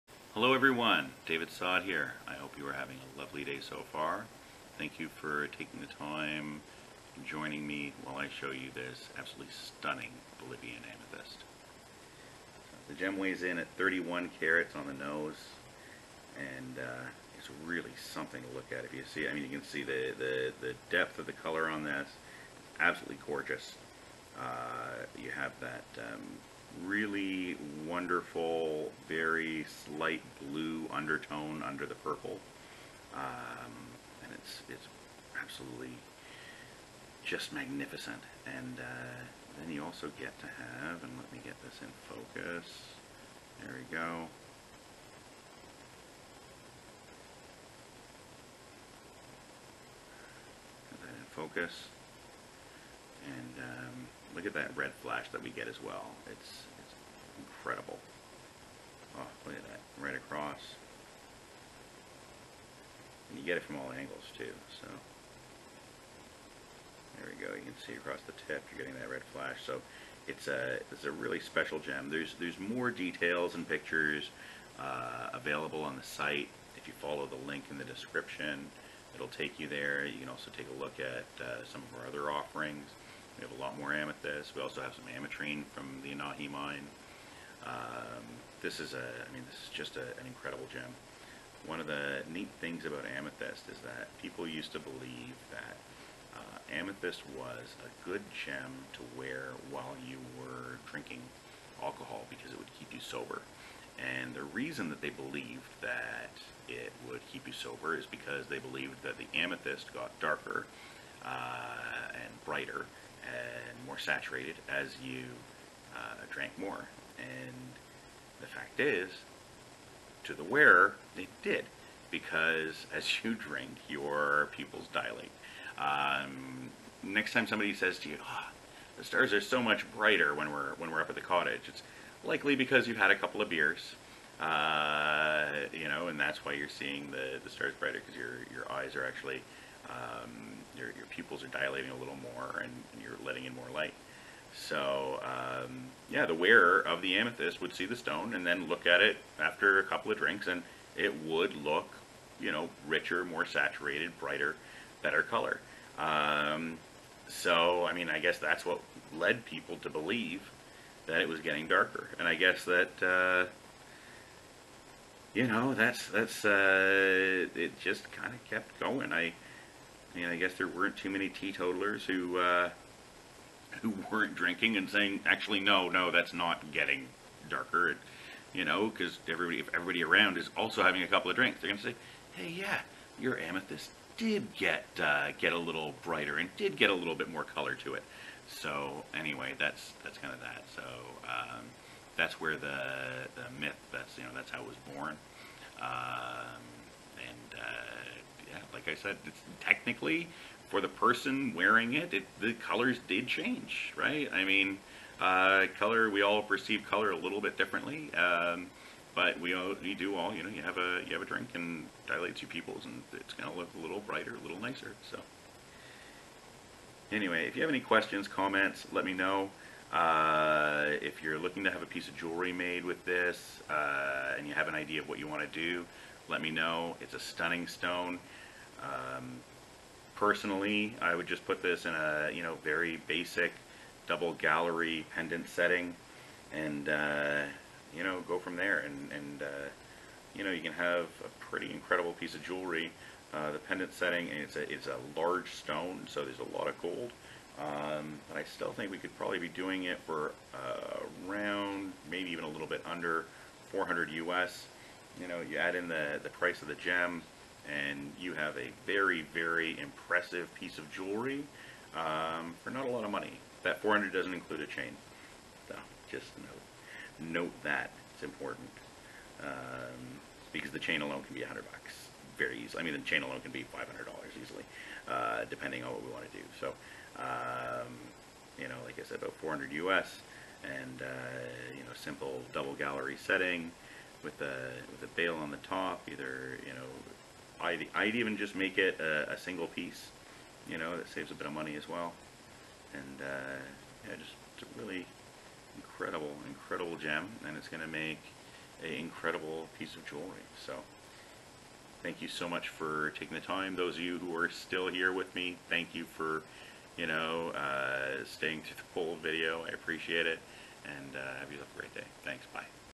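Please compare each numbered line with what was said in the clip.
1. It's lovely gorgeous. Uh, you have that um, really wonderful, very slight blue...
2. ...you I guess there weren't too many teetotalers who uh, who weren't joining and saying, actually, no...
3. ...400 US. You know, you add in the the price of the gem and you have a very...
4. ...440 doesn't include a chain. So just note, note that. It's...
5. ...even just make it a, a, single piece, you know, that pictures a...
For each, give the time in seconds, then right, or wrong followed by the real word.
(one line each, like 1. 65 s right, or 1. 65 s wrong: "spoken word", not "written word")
1. 22 s wrong: "absolutely", not "lovely"
2. 170 s wrong: "drinking", not "joining"
3. 253 s right
4. 263 s wrong: "400", not "440"
5. 288 s wrong: "saves", not "pictures".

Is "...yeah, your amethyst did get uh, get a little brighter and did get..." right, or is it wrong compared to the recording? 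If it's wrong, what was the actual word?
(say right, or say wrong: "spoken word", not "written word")
right.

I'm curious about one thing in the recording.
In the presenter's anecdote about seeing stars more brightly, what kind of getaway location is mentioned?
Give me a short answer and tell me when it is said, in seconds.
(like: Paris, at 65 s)
the cottage, at 131 s.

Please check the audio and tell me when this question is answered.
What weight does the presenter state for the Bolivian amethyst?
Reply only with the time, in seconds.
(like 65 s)
13 s.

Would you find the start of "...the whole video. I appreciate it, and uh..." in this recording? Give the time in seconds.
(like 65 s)
308 s.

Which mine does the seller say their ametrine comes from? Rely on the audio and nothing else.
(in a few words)
Anahi.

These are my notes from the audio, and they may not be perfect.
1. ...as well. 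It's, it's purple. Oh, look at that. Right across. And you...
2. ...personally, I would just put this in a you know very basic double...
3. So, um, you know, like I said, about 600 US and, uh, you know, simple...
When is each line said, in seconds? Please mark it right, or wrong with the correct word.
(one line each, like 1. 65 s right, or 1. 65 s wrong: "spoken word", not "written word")
1. 55 s wrong: "incredible", not "purple"
2. 230 s right
3. 276 s wrong: "400", not "600".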